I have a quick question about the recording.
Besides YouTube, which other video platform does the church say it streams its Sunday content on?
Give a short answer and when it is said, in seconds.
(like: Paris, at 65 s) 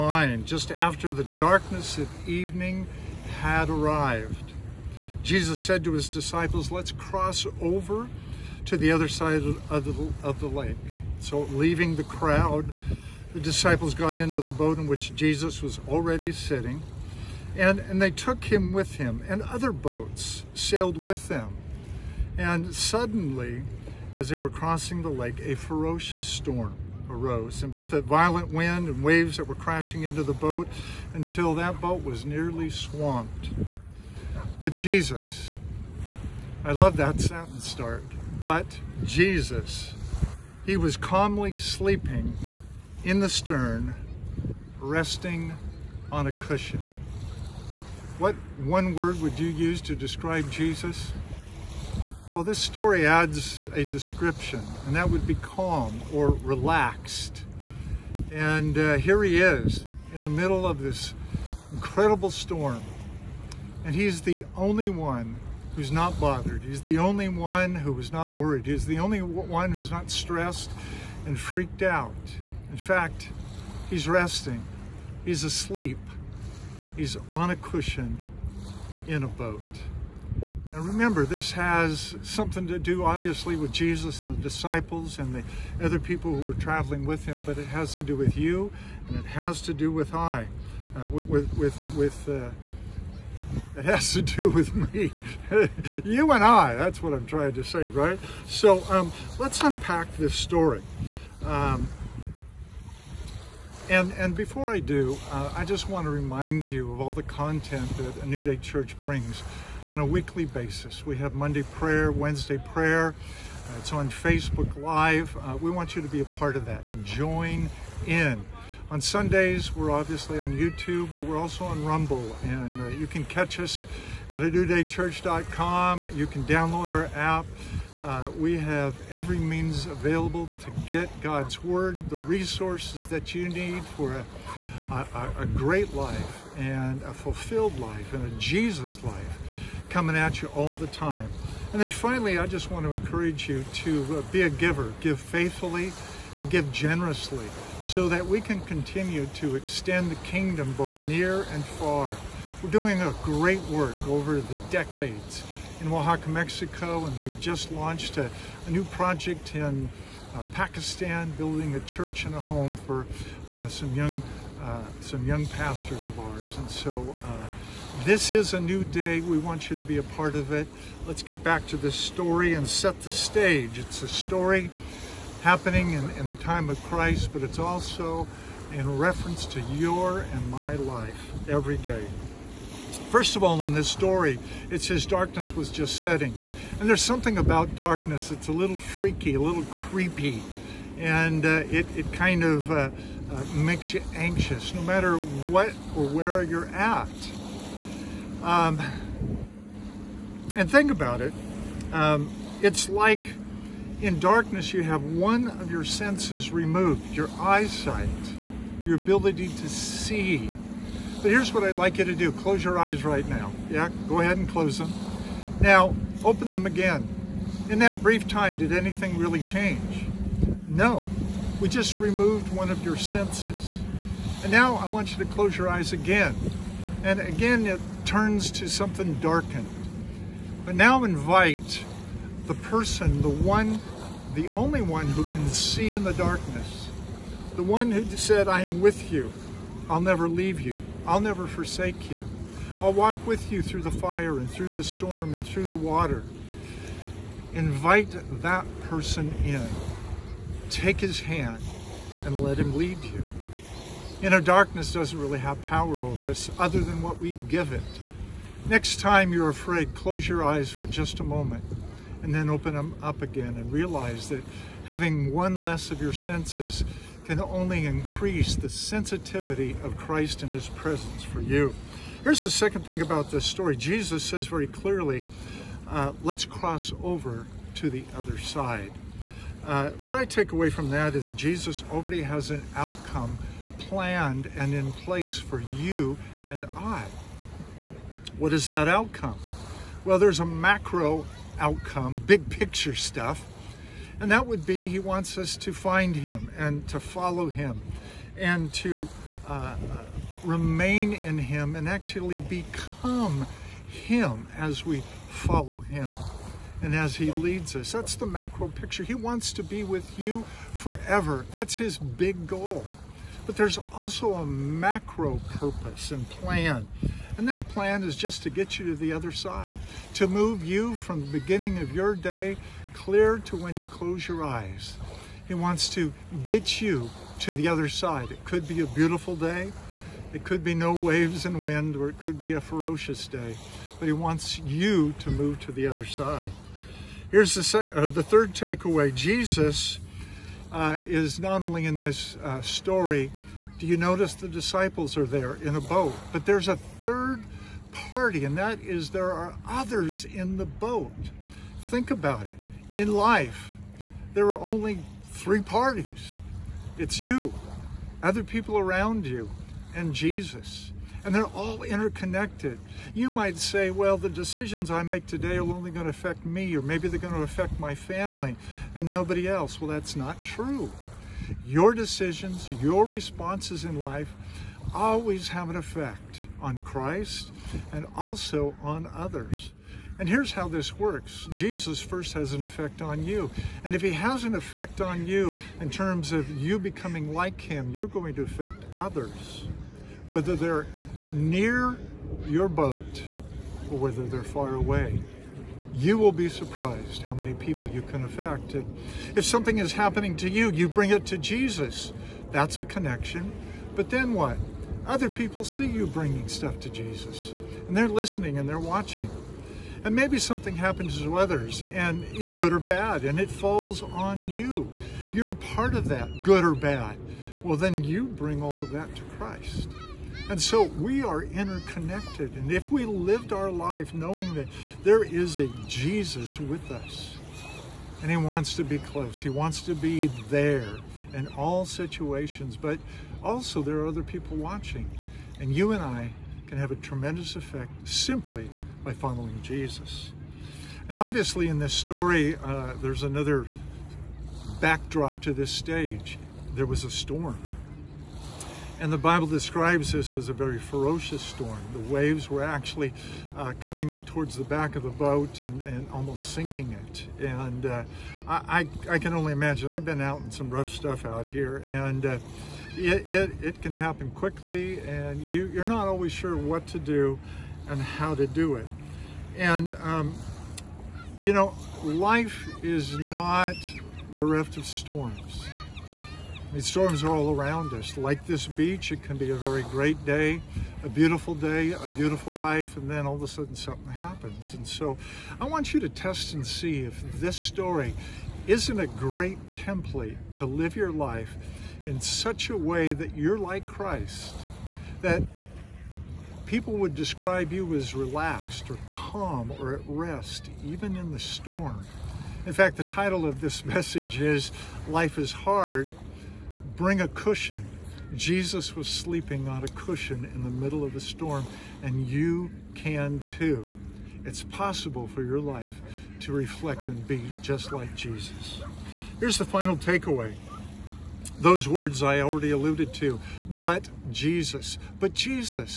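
Rumble, at 121 s.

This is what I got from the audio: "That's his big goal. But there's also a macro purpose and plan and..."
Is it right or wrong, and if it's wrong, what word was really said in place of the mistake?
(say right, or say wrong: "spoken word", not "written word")
right.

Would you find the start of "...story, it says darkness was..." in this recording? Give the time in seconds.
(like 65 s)
183 s.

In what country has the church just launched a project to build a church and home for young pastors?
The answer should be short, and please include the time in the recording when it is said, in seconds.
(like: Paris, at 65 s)
Pakistan, at 160 s.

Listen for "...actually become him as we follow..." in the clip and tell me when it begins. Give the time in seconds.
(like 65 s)
301 s.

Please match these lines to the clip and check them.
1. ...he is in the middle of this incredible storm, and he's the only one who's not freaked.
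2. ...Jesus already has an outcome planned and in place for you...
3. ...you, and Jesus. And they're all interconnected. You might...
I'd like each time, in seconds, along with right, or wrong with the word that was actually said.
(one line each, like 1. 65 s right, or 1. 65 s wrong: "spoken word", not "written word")
1. 59 s wrong: "bothered", not "freaked"
2. 281 s right
3. 359 s right.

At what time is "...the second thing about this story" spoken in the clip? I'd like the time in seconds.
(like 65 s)
272 s.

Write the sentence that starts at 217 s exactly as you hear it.
In that brief time, did anything really change?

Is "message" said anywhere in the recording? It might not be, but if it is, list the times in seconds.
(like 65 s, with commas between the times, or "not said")
503 s.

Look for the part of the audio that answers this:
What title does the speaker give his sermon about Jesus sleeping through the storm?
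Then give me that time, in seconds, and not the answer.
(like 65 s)
505 s.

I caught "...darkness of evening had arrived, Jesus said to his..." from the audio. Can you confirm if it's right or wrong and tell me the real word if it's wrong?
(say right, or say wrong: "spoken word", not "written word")
right.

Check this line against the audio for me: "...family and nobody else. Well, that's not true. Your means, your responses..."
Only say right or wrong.
wrong.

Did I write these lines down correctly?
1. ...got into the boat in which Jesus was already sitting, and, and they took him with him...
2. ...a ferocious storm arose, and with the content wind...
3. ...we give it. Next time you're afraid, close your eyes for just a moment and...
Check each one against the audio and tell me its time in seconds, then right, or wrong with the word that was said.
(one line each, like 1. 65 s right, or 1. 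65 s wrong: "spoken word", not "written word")
1. 13 s right
2. 25 s wrong: "violent", not "content"
3. 257 s right.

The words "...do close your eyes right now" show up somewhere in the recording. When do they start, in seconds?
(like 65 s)
212 s.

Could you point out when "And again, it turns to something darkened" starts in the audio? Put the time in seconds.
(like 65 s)
227 s.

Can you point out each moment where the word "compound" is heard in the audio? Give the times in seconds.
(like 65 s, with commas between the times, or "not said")
not said.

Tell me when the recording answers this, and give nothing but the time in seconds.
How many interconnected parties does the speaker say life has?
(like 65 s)
355 s.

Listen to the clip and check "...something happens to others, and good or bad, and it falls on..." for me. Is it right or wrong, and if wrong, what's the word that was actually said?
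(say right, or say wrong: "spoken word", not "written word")
right.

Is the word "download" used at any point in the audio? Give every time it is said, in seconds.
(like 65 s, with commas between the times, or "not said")
126 s.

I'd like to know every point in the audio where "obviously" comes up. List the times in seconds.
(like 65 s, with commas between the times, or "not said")
83 s, 119 s, 441 s.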